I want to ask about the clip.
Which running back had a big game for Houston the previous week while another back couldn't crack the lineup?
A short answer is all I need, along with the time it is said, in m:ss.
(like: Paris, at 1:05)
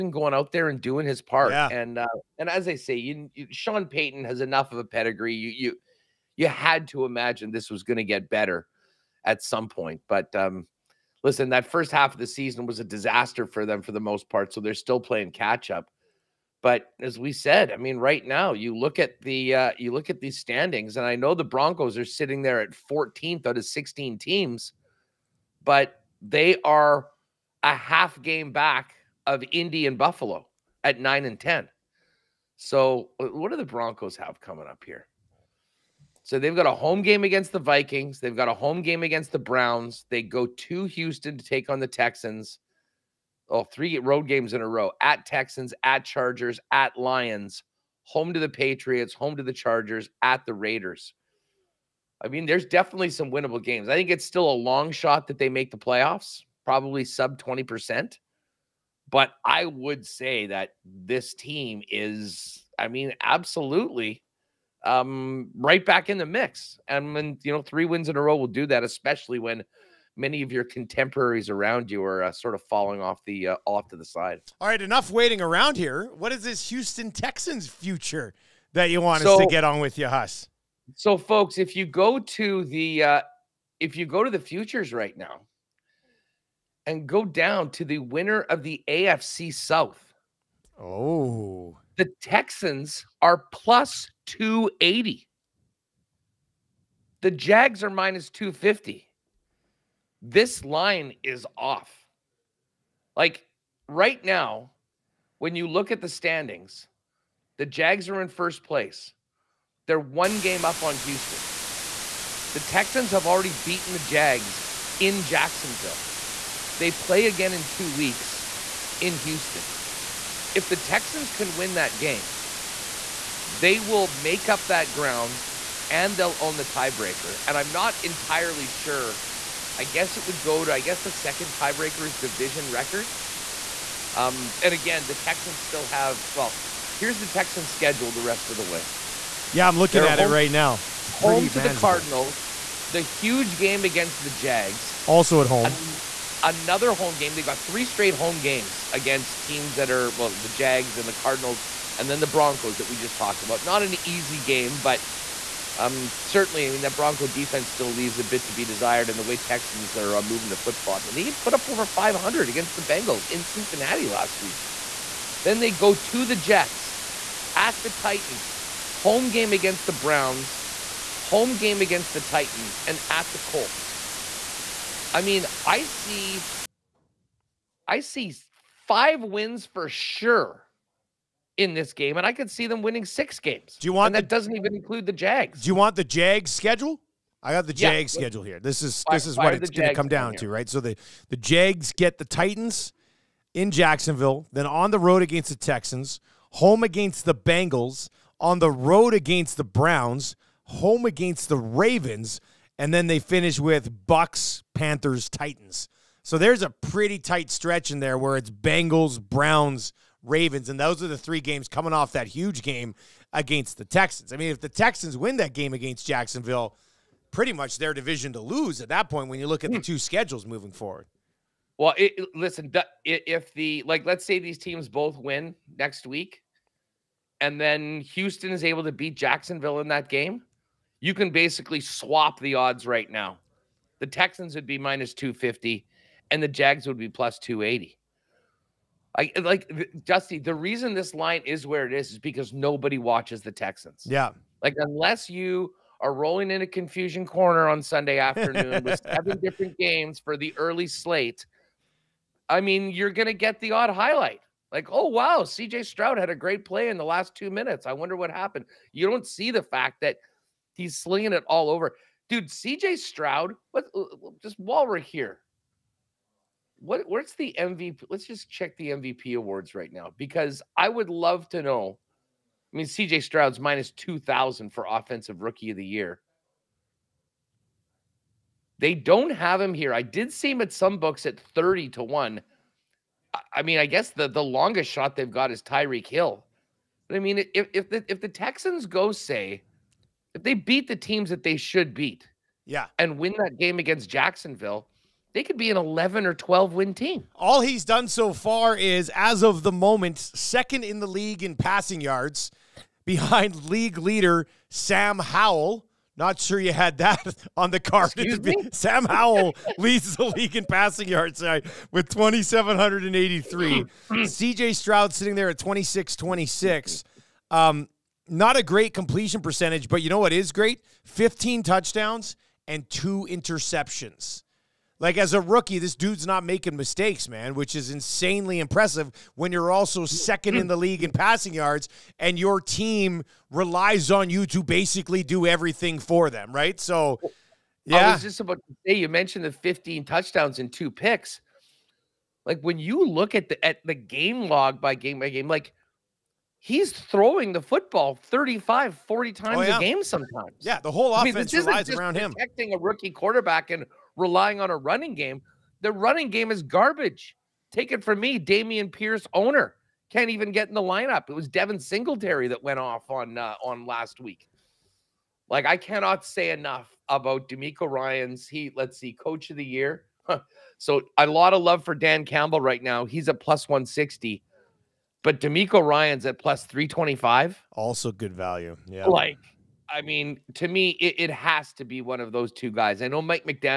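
Devin Singletary, at 6:01.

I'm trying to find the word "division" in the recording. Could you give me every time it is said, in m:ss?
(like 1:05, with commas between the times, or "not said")
2:12, 3:37.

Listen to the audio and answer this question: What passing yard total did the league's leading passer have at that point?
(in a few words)
2,783.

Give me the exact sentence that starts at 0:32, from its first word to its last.
So, uh, what do the Broncos have coming up here?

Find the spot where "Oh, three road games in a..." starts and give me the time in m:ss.
0:43.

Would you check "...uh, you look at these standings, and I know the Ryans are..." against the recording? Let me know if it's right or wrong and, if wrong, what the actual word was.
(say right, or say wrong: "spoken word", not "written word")
wrong: "Broncos", not "Ryans".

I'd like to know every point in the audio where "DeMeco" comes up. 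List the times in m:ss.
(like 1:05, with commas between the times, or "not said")
6:07, 6:15.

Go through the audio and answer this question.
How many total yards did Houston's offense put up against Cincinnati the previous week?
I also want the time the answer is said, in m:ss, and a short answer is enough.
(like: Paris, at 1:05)
over 500, at 2:41.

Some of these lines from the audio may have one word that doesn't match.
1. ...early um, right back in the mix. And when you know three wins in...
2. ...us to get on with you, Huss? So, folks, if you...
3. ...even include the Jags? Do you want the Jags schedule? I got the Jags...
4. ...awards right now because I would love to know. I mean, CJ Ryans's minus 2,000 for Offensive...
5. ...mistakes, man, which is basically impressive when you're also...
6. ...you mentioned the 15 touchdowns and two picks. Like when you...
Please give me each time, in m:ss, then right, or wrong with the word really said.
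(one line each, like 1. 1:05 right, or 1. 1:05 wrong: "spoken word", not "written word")
1. 1:03 wrong: "absolutely", not "early"
2. 1:19 right
3. 3:04 right
4. 4:29 wrong: "Stroud", not "Ryans"
5. 5:26 wrong: "insanely", not "basically"
6. 5:38 right.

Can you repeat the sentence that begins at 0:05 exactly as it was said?
You you you had to imagine this was going to get better at some point.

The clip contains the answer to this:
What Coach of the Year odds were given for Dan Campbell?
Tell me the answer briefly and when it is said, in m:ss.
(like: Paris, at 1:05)
+160, at 6:13.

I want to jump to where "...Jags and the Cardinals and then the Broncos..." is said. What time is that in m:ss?
2:30.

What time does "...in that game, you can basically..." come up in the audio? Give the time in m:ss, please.
3:49.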